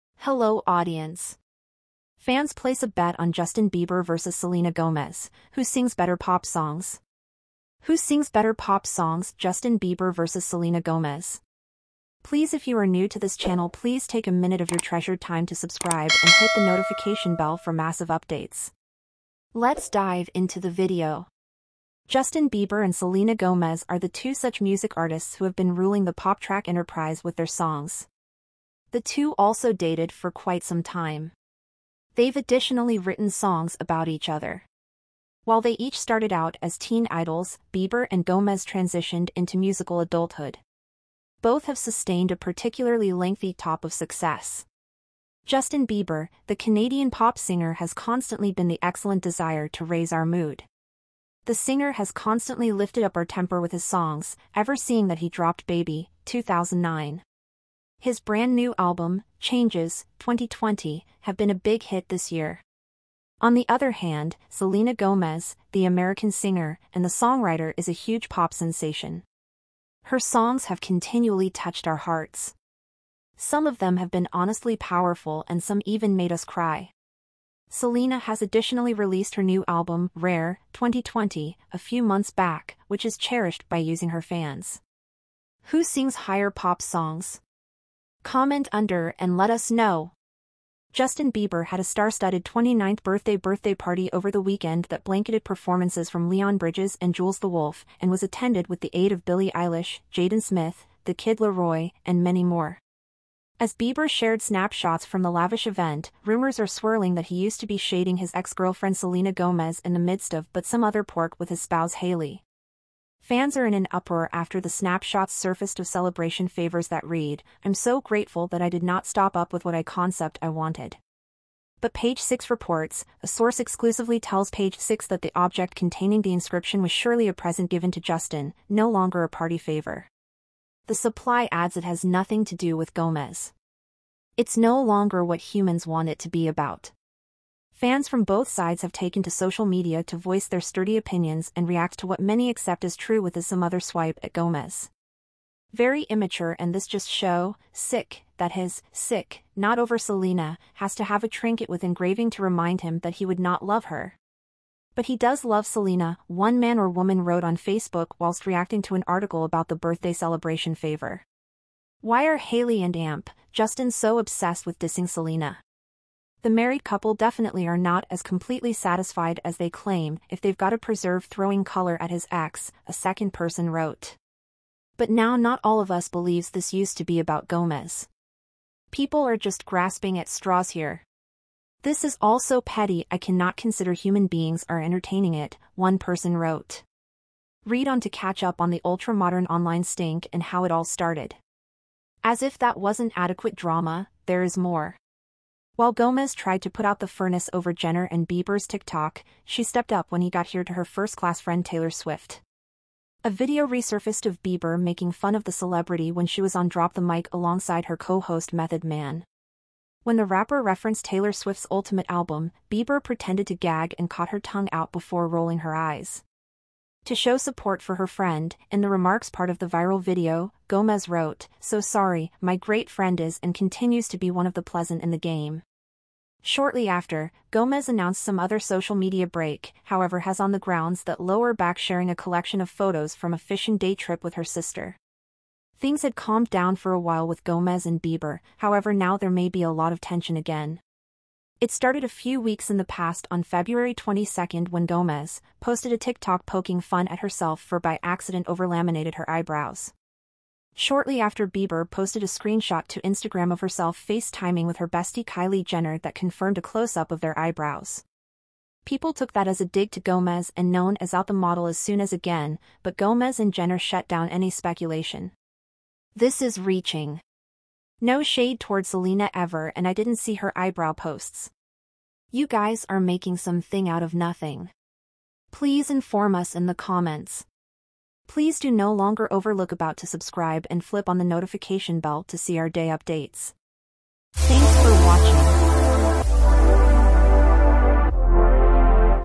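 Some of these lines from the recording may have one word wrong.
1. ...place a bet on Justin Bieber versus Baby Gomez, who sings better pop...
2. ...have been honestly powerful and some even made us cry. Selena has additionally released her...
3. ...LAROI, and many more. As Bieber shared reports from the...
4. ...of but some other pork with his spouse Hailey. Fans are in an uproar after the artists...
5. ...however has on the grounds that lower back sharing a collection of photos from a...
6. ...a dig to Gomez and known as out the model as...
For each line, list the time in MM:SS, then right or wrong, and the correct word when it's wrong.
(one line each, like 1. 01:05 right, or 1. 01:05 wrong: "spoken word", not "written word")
1. 00:02 wrong: "Selena", not "Baby"
2. 01:13 right
3. 01:41 wrong: "snapshots", not "reports"
4. 01:50 wrong: "snapshots", not "artists"
5. 03:49 right
6. 04:19 right.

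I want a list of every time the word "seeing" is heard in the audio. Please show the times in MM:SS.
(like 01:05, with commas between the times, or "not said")
00:54.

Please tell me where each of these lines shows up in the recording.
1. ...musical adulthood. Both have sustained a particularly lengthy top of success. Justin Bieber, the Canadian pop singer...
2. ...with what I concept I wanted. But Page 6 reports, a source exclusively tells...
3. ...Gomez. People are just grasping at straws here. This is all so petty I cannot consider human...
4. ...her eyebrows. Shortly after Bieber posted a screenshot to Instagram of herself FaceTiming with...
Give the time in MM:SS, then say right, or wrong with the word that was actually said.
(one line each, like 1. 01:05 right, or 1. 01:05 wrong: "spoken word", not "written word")
1. 00:39 right
2. 01:59 right
3. 02:57 right
4. 04:09 right.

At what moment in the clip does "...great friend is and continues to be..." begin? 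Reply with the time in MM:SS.
03:42.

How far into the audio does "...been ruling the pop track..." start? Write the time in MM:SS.
00:25.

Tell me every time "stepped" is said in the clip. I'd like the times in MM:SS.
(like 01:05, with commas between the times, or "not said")
03:19.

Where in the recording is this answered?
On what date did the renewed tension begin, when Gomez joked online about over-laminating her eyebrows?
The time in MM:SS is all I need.
04:03.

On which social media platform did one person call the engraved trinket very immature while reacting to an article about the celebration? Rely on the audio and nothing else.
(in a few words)
Facebook.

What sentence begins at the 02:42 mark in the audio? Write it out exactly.
Why are Hailey and Amp, Justin so obsessed with dissing Selena?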